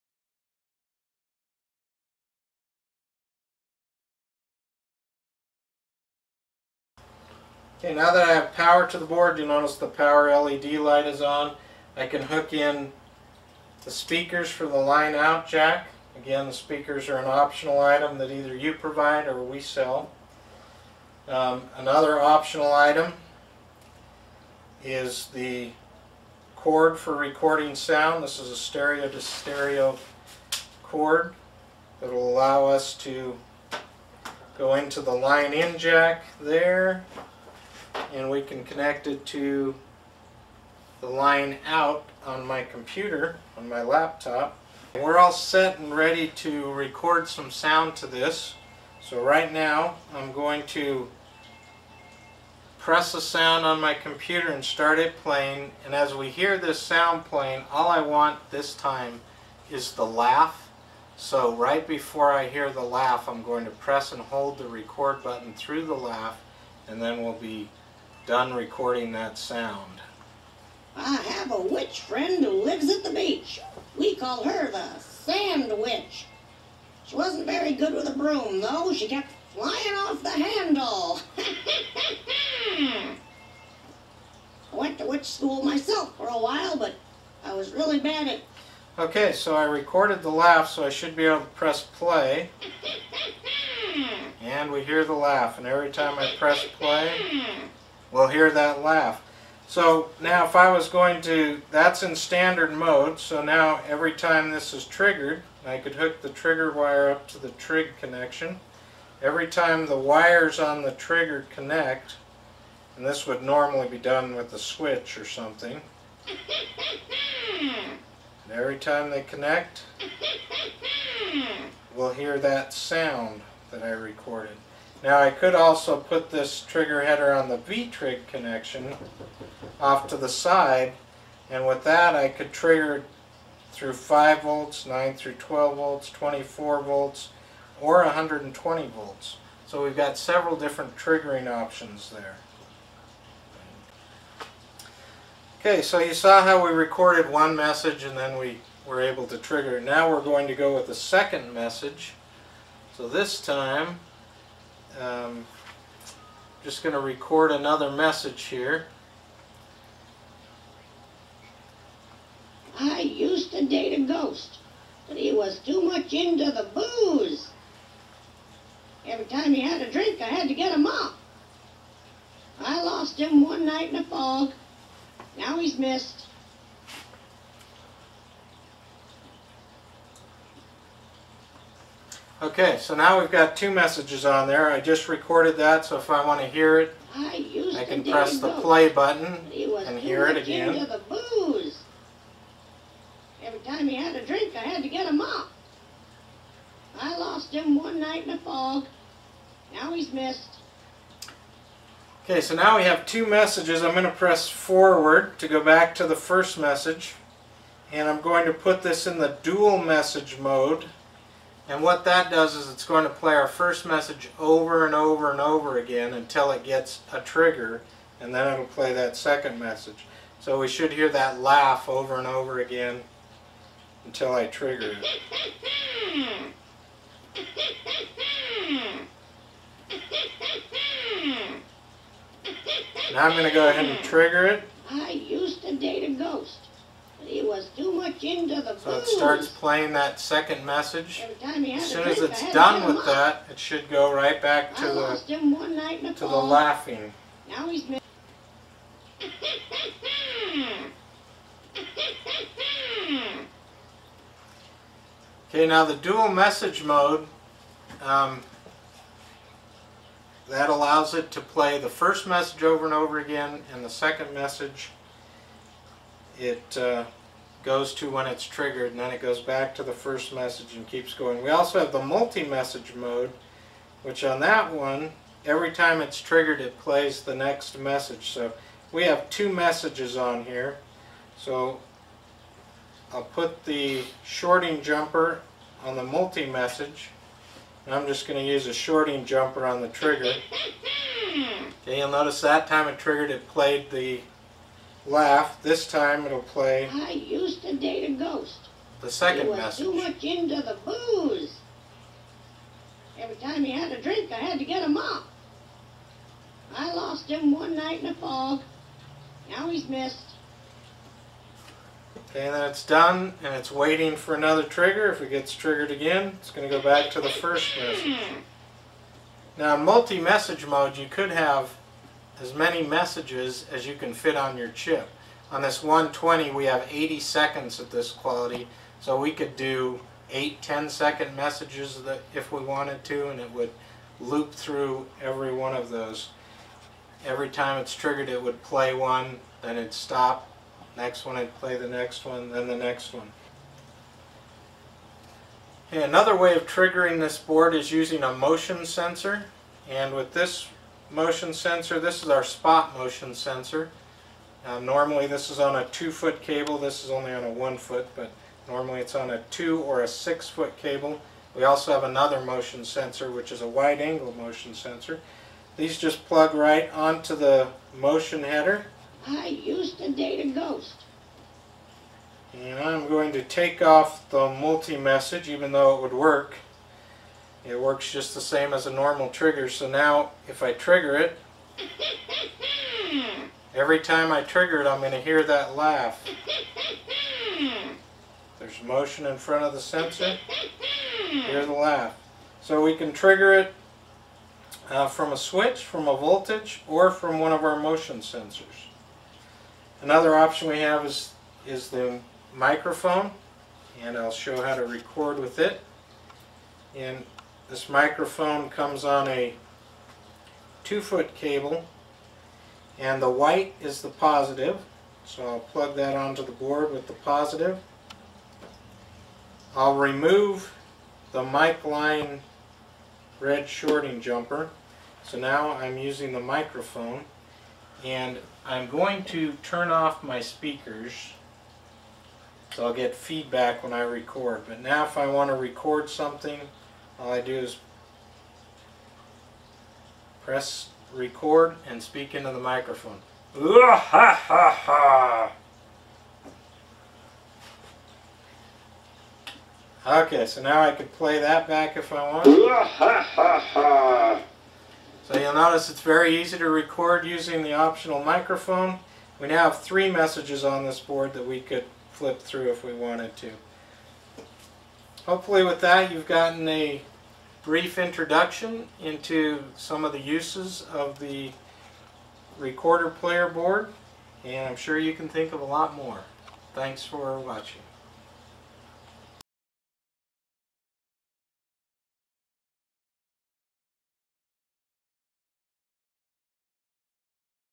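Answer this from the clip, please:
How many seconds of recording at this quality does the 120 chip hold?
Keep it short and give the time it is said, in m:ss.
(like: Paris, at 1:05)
80 seconds, at 5:26.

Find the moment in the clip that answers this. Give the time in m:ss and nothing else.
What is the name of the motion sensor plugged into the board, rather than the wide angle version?
5:52.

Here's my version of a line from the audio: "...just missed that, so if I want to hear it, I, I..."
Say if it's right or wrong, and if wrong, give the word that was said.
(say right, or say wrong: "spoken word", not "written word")
wrong: "recorded", not "missed".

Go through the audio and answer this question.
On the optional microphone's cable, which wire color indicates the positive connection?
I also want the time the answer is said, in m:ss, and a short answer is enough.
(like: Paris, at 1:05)
white, at 6:53.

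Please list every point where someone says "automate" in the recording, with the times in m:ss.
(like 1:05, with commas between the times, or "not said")
not said.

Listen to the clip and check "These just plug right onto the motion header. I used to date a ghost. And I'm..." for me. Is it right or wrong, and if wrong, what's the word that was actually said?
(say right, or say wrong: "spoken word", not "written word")
right.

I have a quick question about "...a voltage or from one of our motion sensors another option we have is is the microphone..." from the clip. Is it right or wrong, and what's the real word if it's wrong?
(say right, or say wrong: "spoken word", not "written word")
right.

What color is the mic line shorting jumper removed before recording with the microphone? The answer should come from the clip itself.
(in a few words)
red.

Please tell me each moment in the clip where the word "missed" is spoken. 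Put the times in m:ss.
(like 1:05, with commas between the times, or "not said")
2:55, 3:20, 5:09.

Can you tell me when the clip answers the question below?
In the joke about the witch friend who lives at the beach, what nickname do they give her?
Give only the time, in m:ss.
1:14.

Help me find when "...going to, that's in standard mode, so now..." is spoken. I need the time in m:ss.
1:40.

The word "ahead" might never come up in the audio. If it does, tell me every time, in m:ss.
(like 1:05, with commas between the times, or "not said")
3:53.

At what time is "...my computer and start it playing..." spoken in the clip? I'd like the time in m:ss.
0:53.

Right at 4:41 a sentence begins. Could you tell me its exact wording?
So I'll put the shorting jumper on the multi-message.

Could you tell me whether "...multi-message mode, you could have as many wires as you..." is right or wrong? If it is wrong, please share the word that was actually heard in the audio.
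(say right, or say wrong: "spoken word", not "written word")
wrong: "messages", not "wires".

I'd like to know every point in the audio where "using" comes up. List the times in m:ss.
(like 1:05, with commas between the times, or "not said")
5:47, 7:05, 7:37.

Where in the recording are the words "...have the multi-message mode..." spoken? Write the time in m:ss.
4:31.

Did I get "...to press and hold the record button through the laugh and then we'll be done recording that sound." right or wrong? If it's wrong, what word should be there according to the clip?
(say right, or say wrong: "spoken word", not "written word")
right.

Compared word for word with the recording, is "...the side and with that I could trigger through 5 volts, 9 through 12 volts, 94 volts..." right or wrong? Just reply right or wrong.
wrong.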